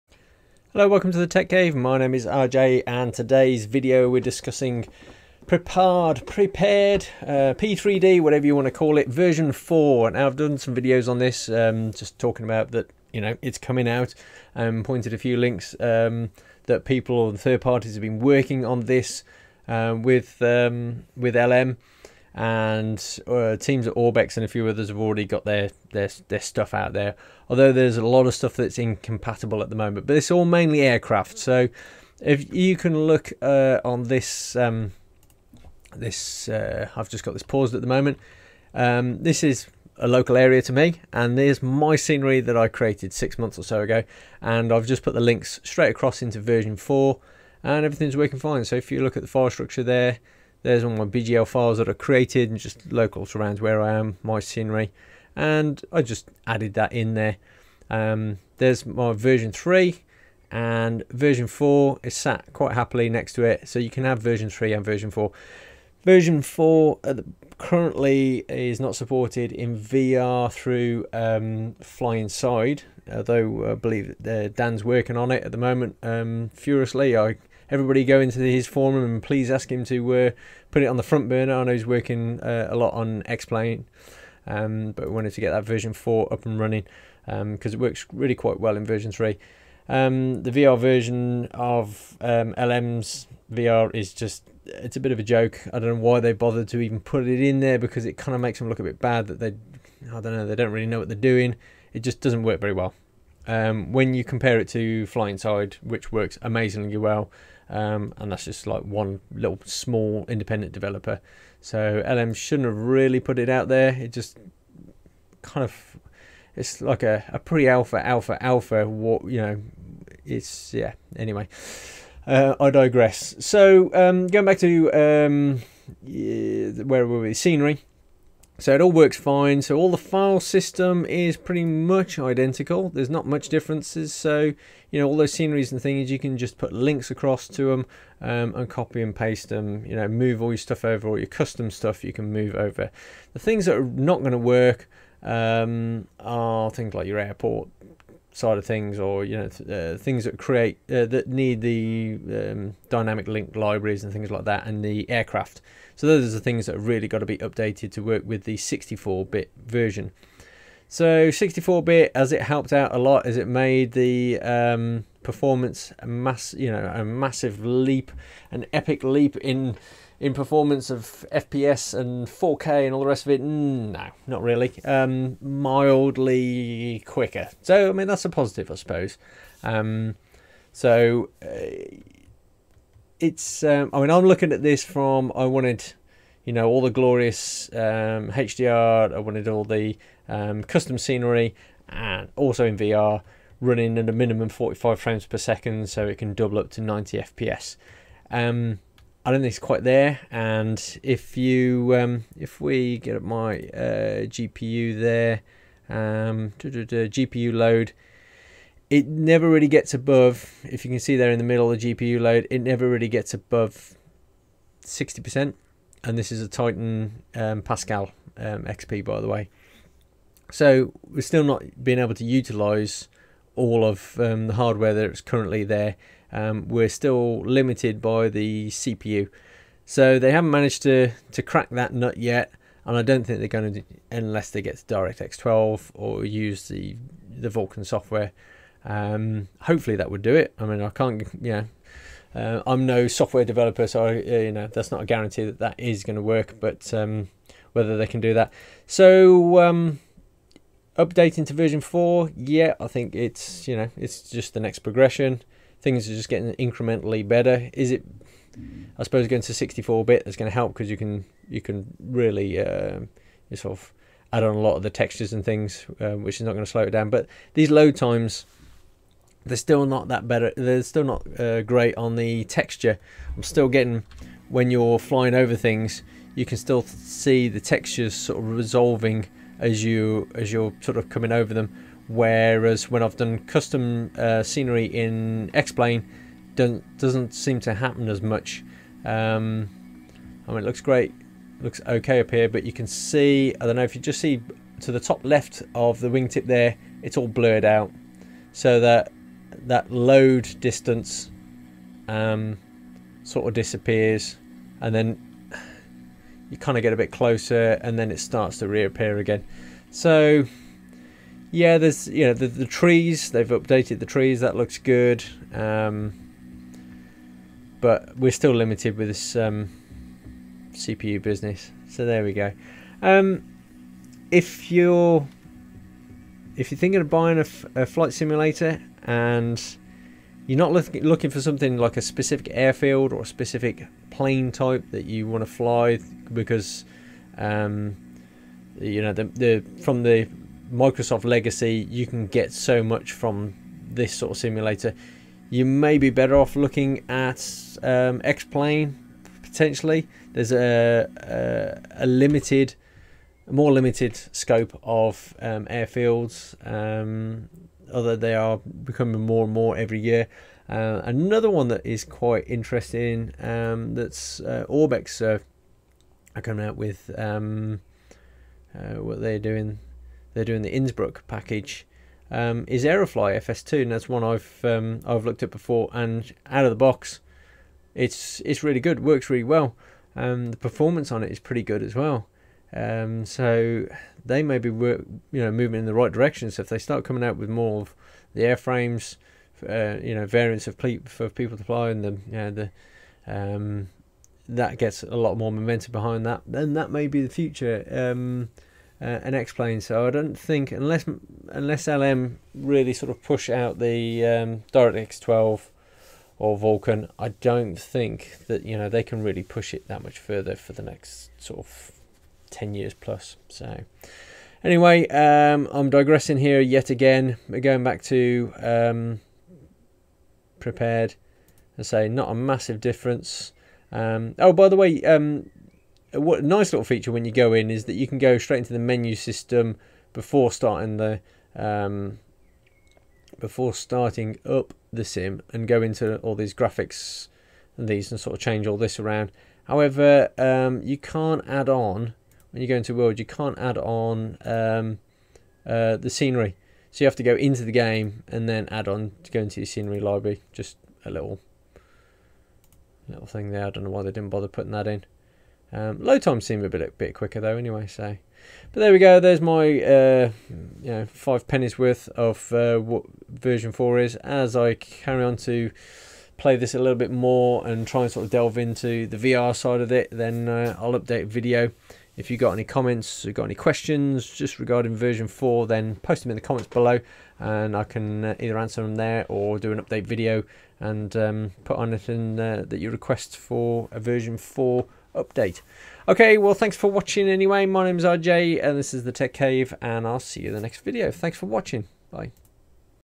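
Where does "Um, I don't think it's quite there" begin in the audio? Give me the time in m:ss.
3:18.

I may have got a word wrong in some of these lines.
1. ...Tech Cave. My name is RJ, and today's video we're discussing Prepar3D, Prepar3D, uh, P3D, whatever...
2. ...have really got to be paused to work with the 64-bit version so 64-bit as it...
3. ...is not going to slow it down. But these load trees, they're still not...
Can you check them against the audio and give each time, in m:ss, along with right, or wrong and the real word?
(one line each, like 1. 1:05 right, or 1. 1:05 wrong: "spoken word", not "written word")
1. 0:01 right
2. 2:36 wrong: "updated", not "paused"
3. 4:26 wrong: "times", not "trees".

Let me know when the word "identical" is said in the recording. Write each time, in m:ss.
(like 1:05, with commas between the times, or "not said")
2:12.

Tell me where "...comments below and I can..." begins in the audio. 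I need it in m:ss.
7:56.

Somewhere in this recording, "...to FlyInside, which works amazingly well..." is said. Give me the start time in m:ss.
1:44.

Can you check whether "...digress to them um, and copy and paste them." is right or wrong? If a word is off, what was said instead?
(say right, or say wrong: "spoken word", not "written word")
wrong: "across", not "digress".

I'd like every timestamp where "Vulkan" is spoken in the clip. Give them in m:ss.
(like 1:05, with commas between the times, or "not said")
3:57, 6:46.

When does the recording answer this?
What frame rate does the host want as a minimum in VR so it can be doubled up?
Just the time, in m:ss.
3:14.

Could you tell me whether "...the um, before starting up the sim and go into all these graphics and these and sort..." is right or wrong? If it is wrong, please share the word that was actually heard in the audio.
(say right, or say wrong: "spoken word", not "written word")
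right.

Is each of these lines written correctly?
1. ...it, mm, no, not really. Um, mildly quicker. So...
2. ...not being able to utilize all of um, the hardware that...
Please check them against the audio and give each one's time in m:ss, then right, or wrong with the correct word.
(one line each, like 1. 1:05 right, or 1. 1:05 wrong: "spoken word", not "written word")
1. 2:53 right
2. 3:41 right.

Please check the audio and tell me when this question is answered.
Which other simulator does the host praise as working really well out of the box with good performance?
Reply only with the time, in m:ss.
6:12.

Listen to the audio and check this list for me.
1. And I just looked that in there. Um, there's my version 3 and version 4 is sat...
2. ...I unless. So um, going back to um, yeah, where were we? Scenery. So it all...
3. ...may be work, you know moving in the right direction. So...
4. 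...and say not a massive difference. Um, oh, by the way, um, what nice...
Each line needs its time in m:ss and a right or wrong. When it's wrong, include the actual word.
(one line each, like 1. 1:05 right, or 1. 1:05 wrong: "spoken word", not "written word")
1. 0:55 wrong: "added", not "looked"
2. 2:02 wrong: "digress", not "unless"
3. 6:24 right
4. 7:01 right.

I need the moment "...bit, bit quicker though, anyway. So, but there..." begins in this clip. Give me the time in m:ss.
7:36.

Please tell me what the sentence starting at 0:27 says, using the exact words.
Although there's a lot of stuff that's incompatible at the moment, but it's all mainly aircraft.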